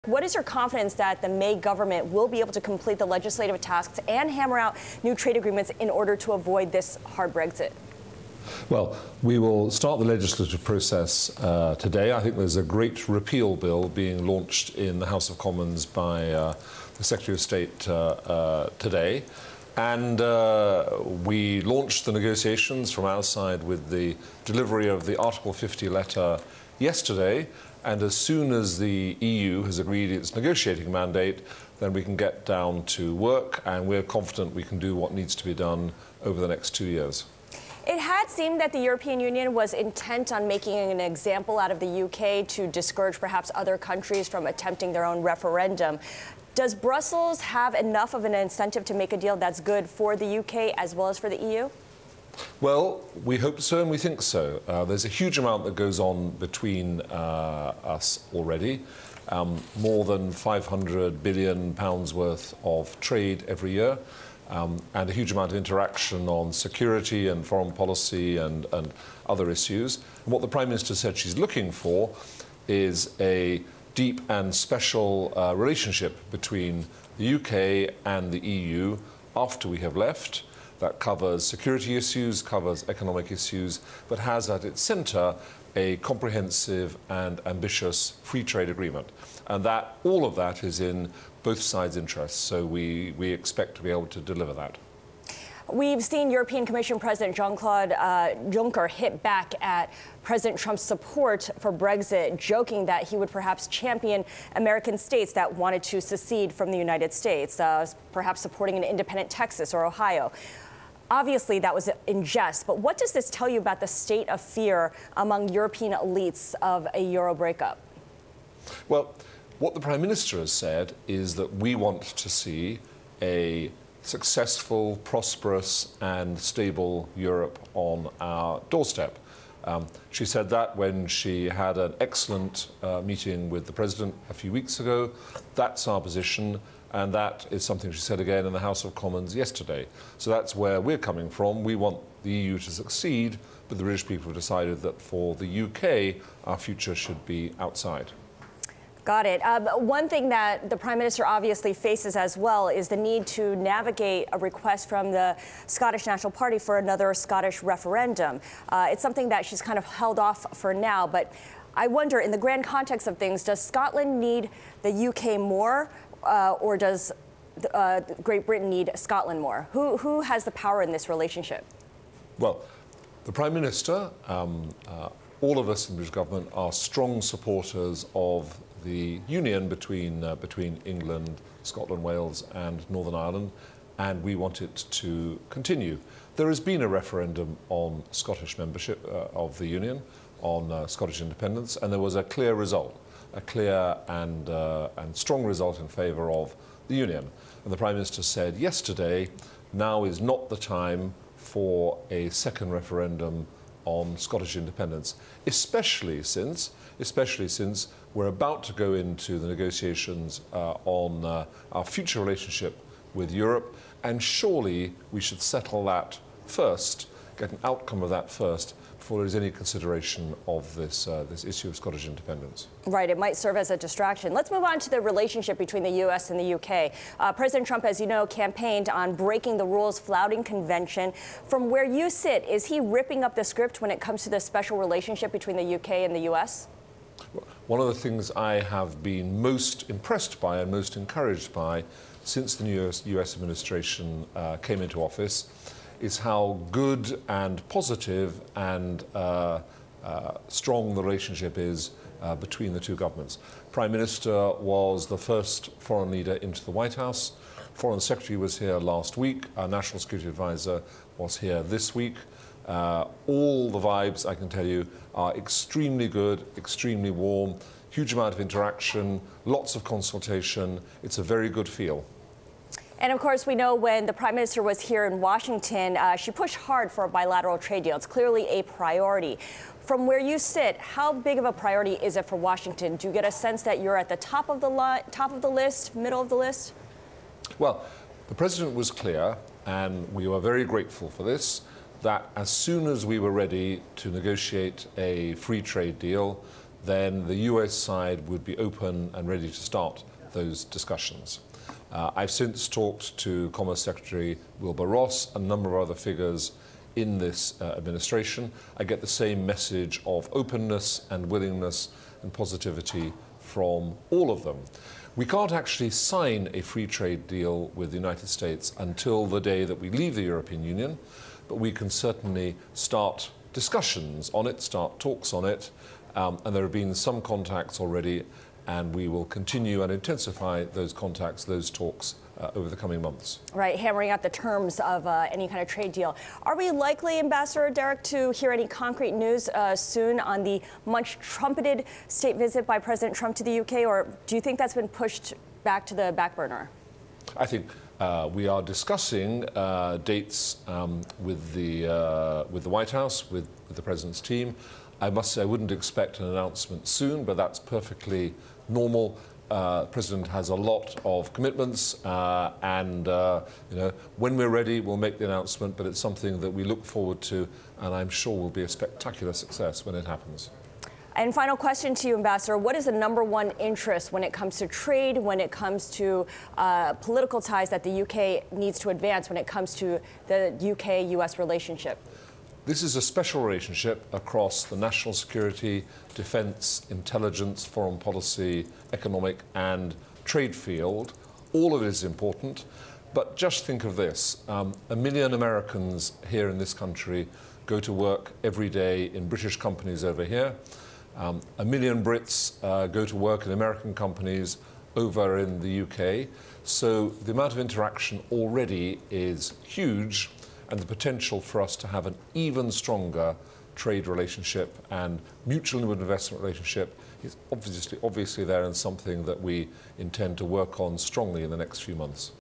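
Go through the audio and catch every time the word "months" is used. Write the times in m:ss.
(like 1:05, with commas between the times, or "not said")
5:33, 7:01.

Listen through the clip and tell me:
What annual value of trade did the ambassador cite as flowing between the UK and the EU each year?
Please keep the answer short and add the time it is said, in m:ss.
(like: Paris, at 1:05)
more than 500 billion pounds, at 1:00.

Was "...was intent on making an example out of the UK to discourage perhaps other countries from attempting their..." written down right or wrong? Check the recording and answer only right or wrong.
right.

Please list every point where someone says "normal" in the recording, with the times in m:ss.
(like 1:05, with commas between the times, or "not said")
5:58.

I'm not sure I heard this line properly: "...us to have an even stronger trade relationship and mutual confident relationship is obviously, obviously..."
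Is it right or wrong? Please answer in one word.
wrong.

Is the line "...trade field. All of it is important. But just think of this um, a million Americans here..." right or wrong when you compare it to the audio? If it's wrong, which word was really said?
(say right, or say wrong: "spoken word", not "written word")
right.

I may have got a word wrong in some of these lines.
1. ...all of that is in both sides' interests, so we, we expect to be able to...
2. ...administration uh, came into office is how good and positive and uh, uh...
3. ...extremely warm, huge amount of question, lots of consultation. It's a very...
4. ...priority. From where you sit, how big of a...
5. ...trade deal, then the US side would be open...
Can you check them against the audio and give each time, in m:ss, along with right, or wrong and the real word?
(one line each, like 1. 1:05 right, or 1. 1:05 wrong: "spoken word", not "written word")
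1. 1:30 right
2. 4:03 right
3. 4:26 wrong: "interaction", not "question"
4. 4:38 right
5. 4:55 right.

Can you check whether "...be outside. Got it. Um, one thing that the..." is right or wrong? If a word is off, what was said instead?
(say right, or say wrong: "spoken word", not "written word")
right.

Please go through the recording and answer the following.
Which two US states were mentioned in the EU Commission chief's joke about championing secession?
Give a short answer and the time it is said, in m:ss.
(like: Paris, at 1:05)
Texas or Ohio, at 1:49.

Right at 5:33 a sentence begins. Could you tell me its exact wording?
Right, hammering out the terms of uh, any kind of trade deal.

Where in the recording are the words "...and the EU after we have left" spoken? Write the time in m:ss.
1:18.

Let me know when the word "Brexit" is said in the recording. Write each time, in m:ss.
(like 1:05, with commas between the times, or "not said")
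0:07, 1:41.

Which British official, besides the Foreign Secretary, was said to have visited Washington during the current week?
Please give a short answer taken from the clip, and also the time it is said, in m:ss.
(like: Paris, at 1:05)
National Security Advisor, at 4:19.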